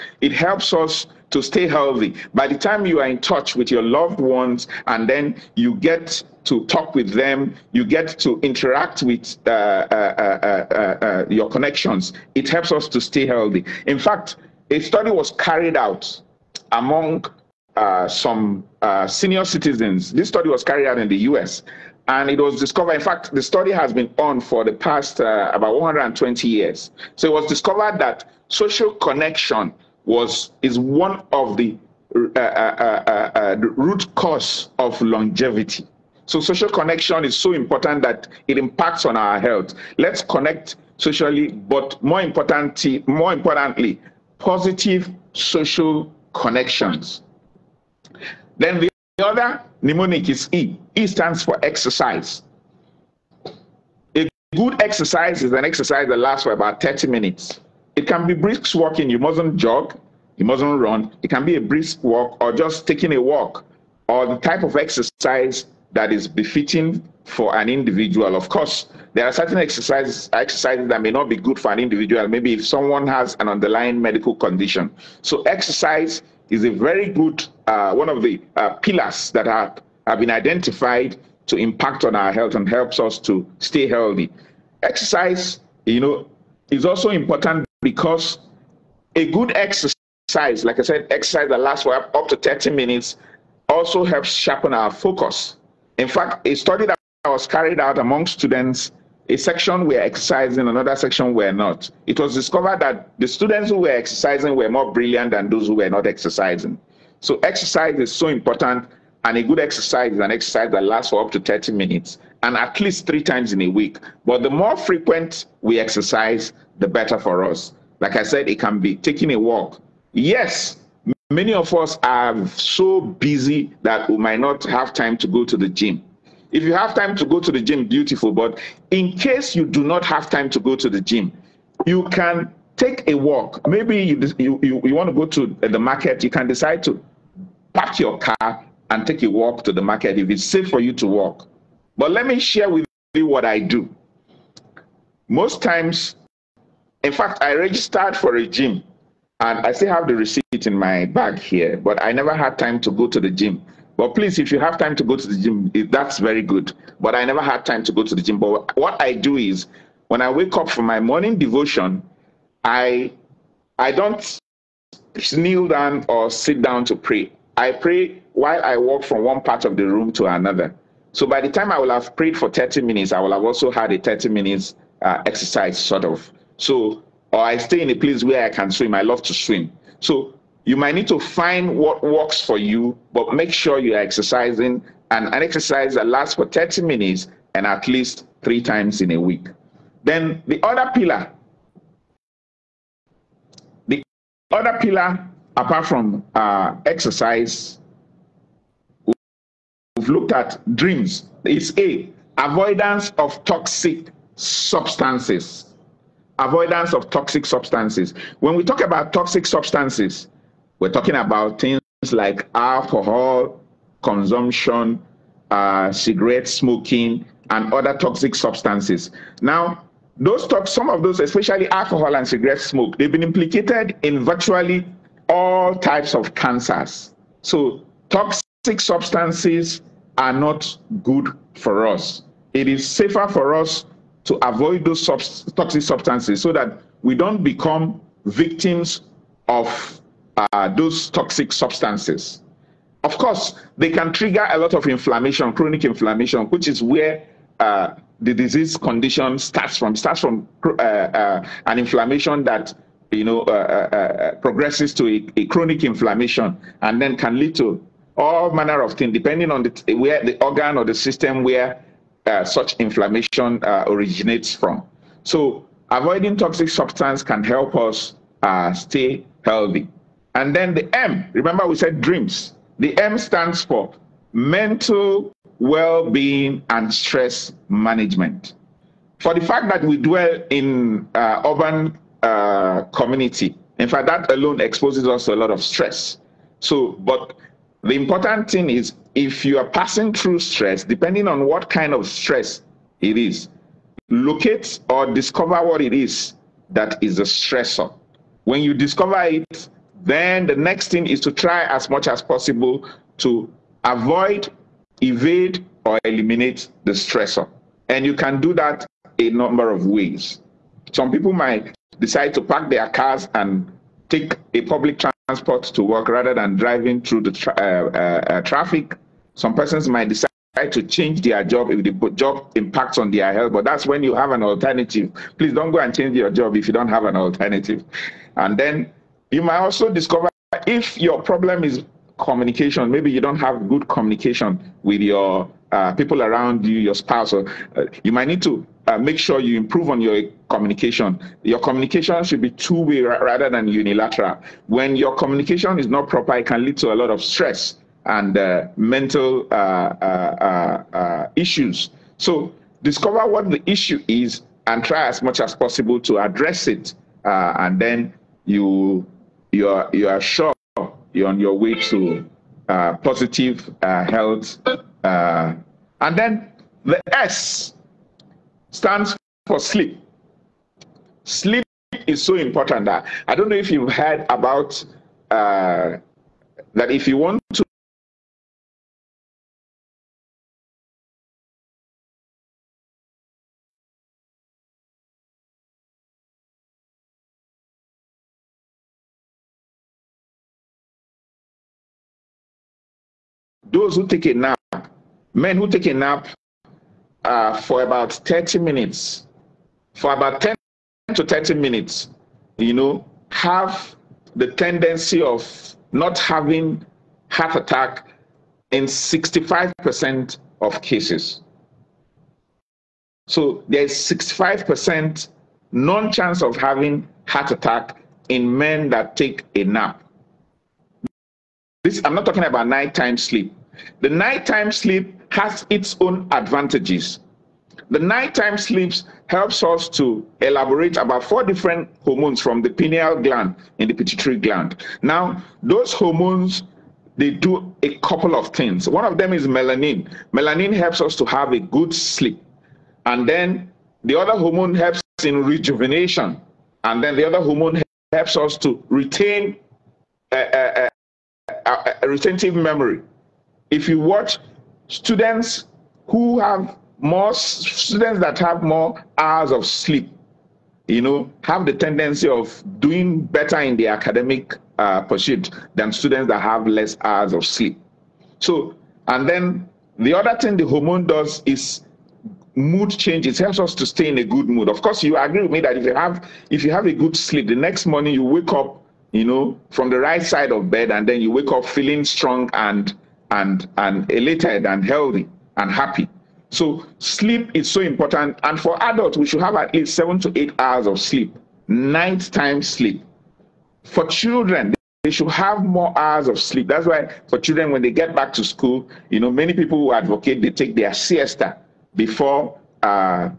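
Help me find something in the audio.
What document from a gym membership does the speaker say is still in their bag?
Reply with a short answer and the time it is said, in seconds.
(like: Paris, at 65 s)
The receipt, at 150 s.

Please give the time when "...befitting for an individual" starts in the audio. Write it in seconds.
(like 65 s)
66 s.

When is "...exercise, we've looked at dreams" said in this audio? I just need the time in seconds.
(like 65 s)
196 s.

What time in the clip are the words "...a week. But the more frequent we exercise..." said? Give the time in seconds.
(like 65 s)
113 s.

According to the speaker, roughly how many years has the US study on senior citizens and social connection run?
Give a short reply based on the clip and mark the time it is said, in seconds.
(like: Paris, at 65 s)
120 years, at 25 s.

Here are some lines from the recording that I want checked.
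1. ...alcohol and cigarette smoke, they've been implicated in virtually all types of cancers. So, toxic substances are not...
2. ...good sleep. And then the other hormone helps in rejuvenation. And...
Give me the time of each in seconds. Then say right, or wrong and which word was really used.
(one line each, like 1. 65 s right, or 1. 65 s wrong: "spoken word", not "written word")
1. 221 s right
2. 441 s right.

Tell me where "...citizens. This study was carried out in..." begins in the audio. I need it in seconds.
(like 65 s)
19 s.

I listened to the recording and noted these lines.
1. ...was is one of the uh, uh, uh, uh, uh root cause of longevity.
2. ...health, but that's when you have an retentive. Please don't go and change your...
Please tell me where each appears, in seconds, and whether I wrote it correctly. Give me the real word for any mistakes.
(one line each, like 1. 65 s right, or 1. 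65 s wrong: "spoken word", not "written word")
1. 30 s right
2. 323 s wrong: "alternative", not "retentive".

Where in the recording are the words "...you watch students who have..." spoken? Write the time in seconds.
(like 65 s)
453 s.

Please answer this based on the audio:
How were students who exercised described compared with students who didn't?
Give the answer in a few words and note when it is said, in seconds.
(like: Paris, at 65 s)
More brilliant, at 104 s.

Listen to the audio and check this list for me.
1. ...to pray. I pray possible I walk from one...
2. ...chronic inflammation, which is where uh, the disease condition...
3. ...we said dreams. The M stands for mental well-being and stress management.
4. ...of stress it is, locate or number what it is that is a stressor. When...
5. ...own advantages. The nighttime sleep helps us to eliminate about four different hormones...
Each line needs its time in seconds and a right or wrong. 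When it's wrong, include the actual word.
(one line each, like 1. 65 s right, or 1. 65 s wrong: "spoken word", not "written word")
1. 166 s wrong: "while", not "possible"
2. 245 s right
3. 271 s right
4. 291 s wrong: "discover", not "number"
5. 425 s wrong: "elaborate", not "eliminate".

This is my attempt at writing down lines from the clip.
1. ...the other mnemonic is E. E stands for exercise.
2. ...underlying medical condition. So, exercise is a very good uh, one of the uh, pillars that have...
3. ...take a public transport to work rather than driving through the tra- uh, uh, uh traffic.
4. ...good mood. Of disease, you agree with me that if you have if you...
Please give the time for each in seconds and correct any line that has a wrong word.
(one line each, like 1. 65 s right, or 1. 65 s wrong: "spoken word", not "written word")
1. 48 s right
2. 73 s right
3. 314 s right
4. 474 s wrong: "course", not "disease".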